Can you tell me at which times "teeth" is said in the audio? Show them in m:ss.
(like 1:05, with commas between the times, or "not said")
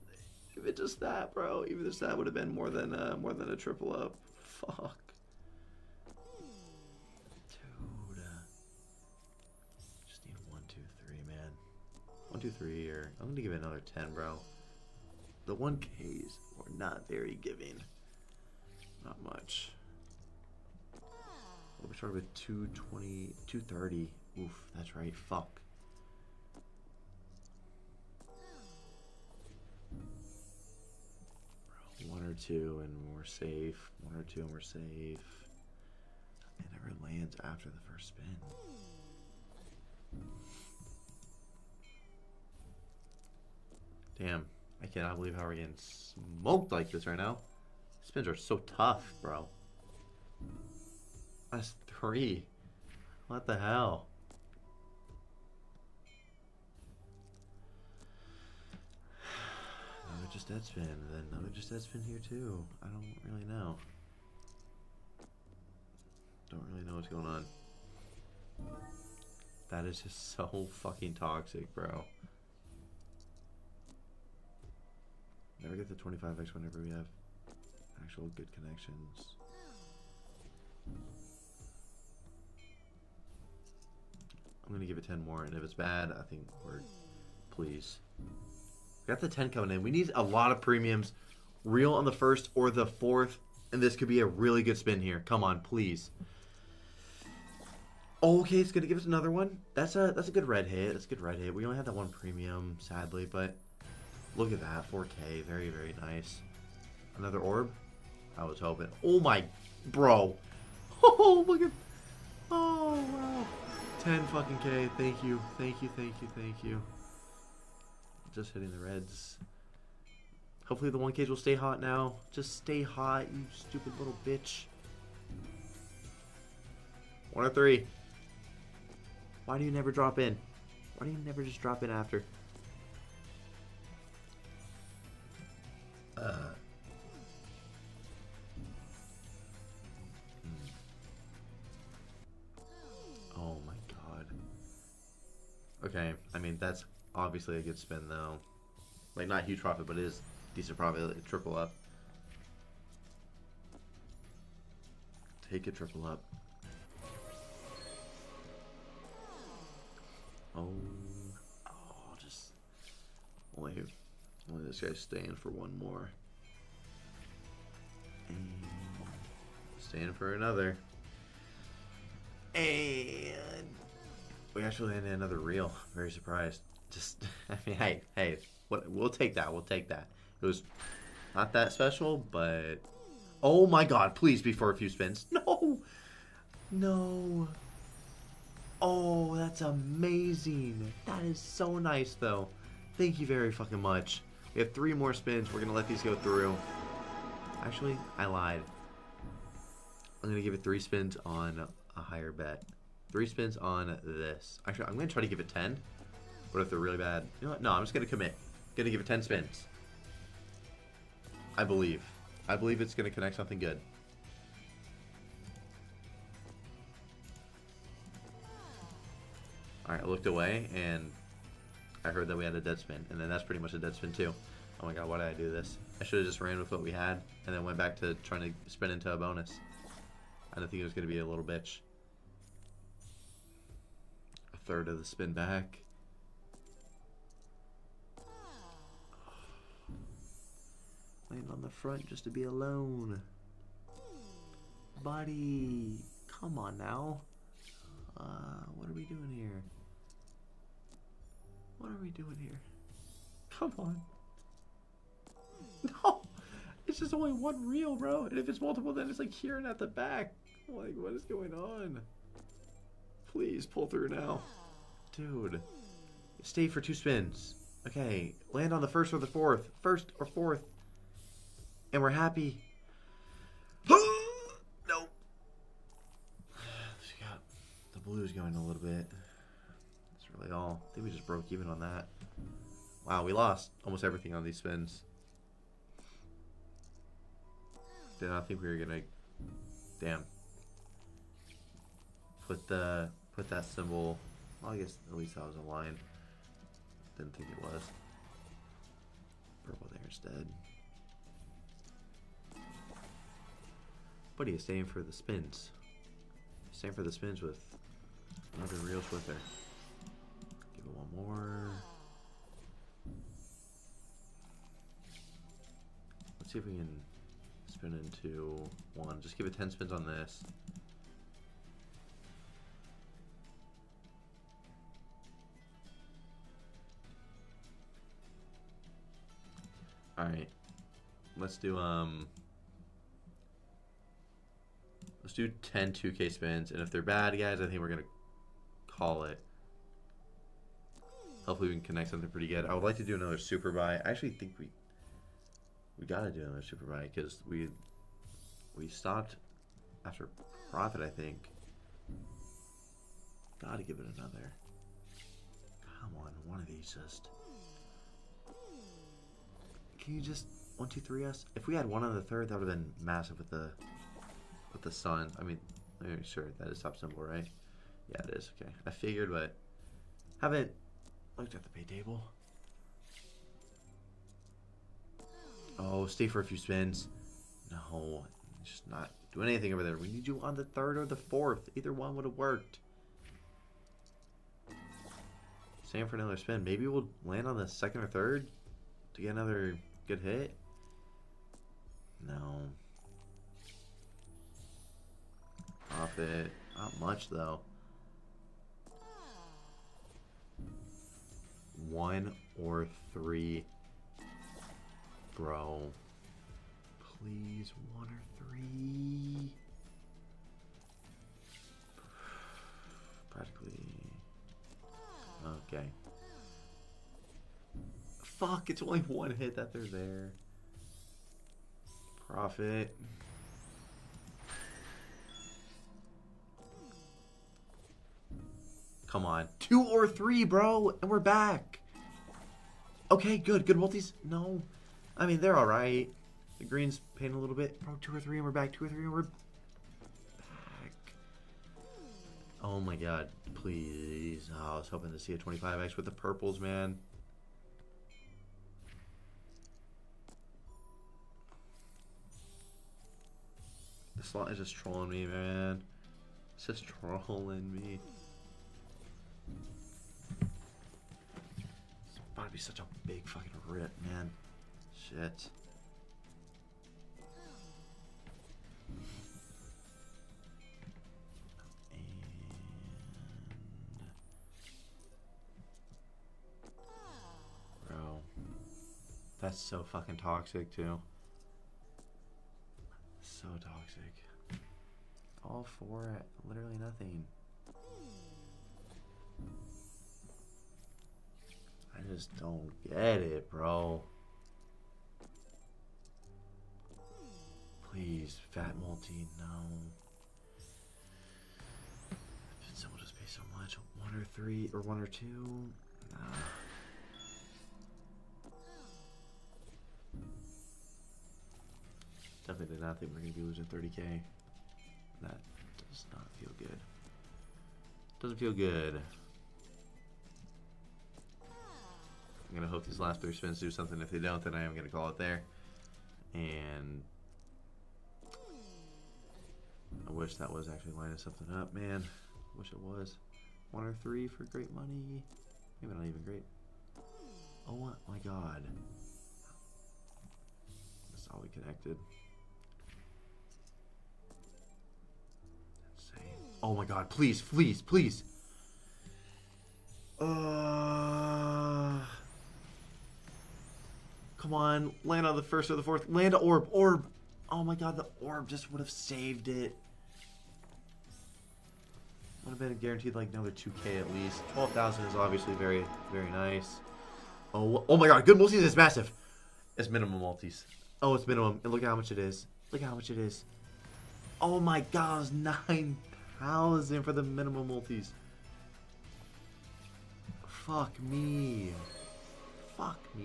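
not said.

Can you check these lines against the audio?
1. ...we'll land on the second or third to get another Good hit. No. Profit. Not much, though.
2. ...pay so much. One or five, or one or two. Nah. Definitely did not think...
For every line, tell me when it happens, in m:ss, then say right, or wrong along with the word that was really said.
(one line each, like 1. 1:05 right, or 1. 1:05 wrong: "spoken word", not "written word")
1. 6:26 right
2. 8:23 wrong: "three", not "five".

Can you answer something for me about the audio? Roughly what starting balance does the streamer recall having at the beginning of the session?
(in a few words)
220, 230.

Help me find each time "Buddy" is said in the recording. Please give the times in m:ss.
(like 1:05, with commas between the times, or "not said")
4:05.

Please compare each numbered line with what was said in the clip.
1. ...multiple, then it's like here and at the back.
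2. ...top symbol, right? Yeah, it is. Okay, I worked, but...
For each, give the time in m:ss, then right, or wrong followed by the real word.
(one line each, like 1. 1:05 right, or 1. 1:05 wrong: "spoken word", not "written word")
1. 4:18 right
2. 6:06 wrong: "figured", not "worked".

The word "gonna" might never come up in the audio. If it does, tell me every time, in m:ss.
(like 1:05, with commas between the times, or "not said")
0:13, 1:24, 1:38, 8:33.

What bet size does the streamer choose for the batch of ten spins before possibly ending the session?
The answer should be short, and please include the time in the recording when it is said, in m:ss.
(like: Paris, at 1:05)
2k, at 5:35.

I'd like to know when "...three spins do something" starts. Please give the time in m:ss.
8:43.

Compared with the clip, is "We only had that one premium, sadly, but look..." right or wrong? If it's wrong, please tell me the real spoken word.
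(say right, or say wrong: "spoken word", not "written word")
right.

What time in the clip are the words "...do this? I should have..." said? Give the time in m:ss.
3:45.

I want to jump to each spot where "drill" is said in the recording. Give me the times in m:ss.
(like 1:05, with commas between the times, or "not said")
not said.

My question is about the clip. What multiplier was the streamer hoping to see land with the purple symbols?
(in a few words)
25x.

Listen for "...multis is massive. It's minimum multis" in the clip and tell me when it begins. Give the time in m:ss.
9:28.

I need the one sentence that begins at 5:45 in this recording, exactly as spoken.
We gotta do another super buy, because we...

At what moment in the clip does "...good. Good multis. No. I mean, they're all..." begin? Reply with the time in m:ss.
7:13.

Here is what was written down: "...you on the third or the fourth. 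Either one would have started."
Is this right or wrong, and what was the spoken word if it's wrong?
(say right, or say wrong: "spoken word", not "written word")
wrong: "worked", not "started".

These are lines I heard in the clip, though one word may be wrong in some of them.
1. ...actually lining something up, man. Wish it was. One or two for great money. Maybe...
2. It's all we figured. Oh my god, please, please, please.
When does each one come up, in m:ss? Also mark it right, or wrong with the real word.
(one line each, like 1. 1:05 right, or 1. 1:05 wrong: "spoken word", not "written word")
1. 8:50 wrong: "three", not "two"
2. 9:01 wrong: "connected", not "figured".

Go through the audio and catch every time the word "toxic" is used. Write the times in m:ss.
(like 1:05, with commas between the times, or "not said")
1:11, 8:00.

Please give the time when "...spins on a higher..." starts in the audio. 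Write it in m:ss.
3:20.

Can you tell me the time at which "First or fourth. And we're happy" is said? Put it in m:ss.
4:29.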